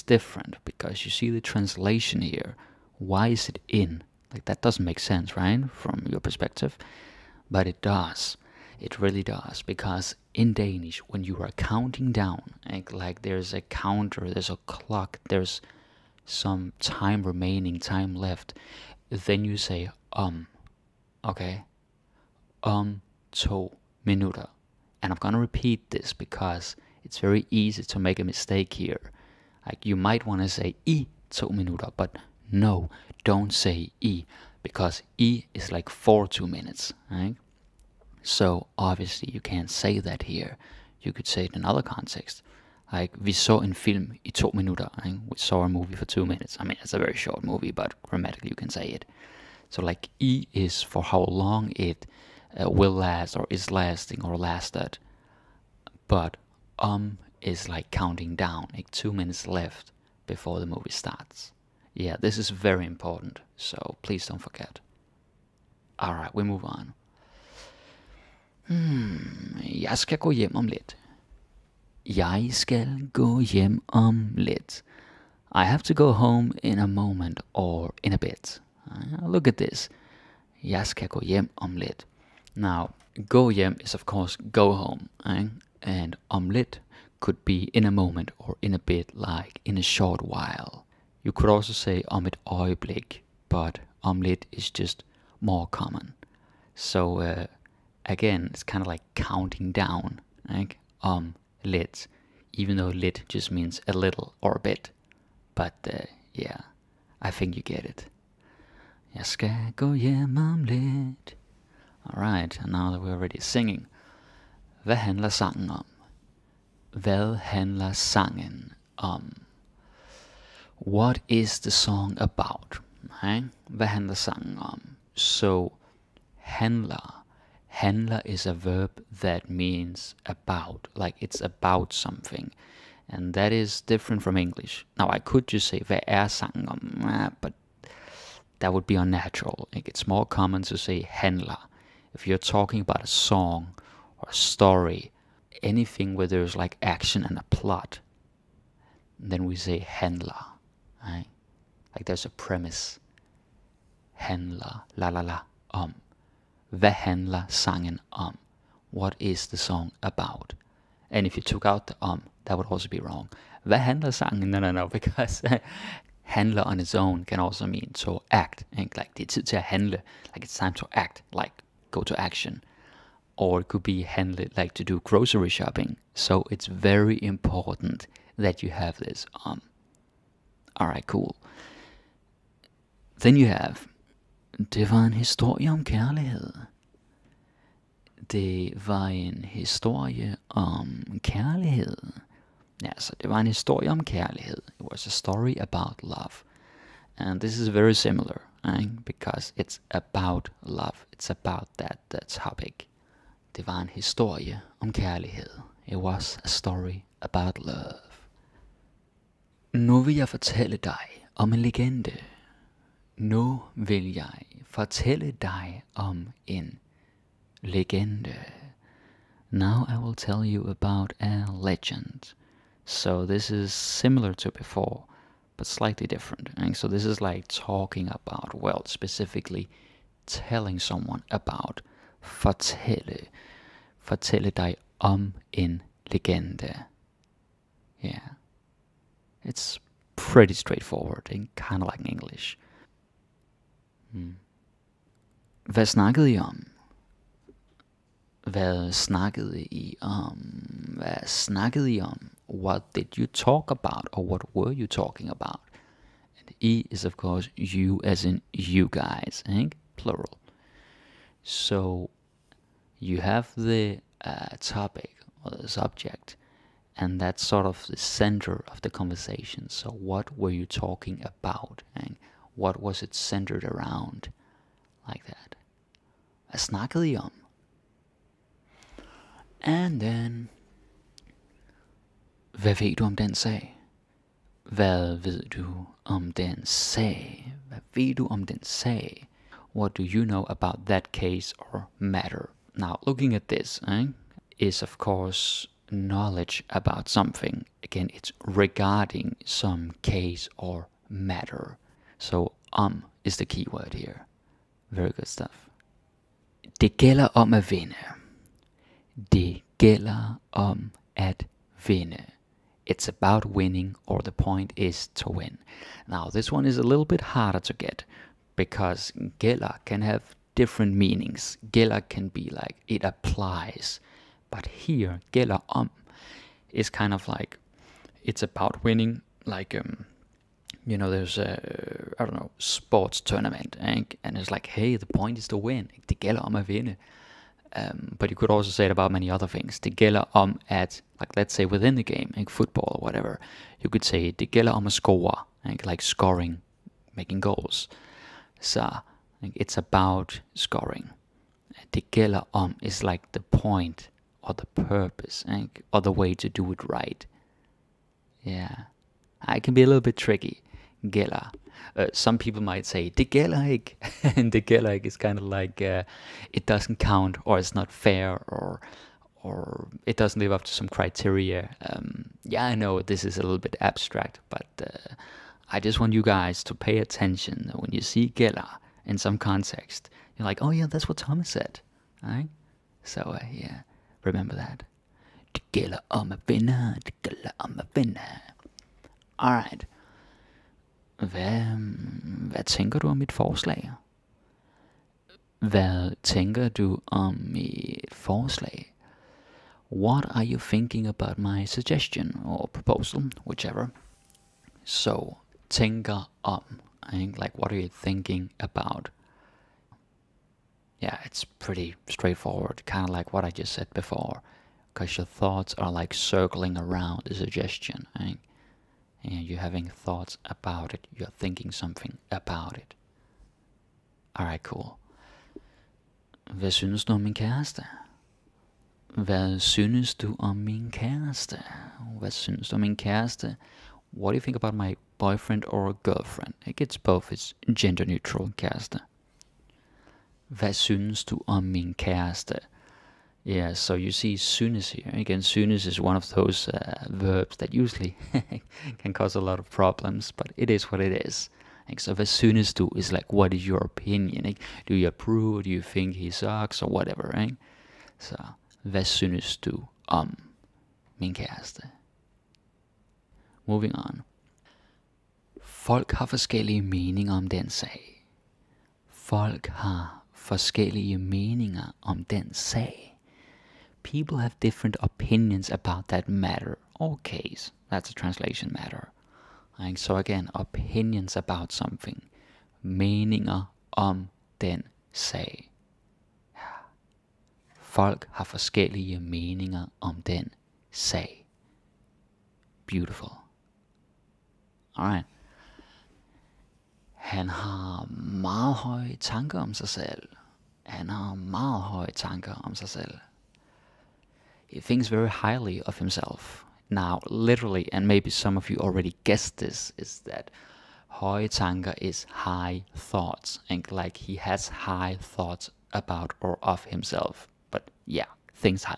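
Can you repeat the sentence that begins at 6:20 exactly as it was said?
You're like, oh yeah, that's what Thomas said, right?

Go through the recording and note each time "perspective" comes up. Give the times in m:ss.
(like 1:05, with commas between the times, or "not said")
0:06.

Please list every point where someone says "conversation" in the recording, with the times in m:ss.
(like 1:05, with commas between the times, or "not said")
4:28.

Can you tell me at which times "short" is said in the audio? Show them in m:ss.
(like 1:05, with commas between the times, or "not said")
0:47, 1:29.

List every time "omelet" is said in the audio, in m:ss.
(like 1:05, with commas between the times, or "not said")
1:26, 1:34.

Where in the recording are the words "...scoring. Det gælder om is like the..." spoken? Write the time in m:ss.
5:50.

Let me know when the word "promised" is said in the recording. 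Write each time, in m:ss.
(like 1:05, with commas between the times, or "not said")
not said.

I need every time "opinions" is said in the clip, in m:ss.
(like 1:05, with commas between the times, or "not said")
7:33, 7:55, 8:00.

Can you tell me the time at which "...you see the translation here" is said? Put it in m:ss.
0:01.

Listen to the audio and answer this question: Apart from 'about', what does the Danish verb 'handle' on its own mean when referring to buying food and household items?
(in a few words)
to do grocery shopping.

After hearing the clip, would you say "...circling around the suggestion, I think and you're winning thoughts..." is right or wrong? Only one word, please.
wrong.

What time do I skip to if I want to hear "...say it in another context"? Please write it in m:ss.
0:41.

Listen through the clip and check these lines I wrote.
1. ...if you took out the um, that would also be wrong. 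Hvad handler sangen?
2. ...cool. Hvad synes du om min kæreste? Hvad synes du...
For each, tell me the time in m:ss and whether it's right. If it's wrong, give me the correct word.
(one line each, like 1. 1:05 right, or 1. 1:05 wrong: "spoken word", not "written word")
1. 2:41 right
2. 7:04 right.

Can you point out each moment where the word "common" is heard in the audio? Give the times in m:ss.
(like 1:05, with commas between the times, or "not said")
1:35, 2:20.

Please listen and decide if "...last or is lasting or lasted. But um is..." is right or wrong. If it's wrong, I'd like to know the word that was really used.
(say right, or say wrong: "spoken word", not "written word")
right.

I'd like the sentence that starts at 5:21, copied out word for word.
Gælder can be like it applies.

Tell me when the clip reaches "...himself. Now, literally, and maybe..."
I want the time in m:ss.
8:25.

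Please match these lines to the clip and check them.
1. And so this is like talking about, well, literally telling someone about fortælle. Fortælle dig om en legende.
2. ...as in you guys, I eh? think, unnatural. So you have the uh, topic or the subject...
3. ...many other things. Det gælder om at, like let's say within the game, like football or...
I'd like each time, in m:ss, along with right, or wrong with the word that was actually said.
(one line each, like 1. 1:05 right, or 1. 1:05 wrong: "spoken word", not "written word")
1. 3:46 wrong: "specifically", not "literally"
2. 4:18 wrong: "plural", not "unnatural"
3. 5:39 right.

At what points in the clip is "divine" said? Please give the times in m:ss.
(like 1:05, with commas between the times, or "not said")
not said.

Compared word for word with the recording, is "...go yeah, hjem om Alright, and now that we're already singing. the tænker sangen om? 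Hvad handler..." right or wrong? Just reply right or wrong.
wrong.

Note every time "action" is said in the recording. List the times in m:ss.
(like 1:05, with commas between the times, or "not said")
2:26, 2:52.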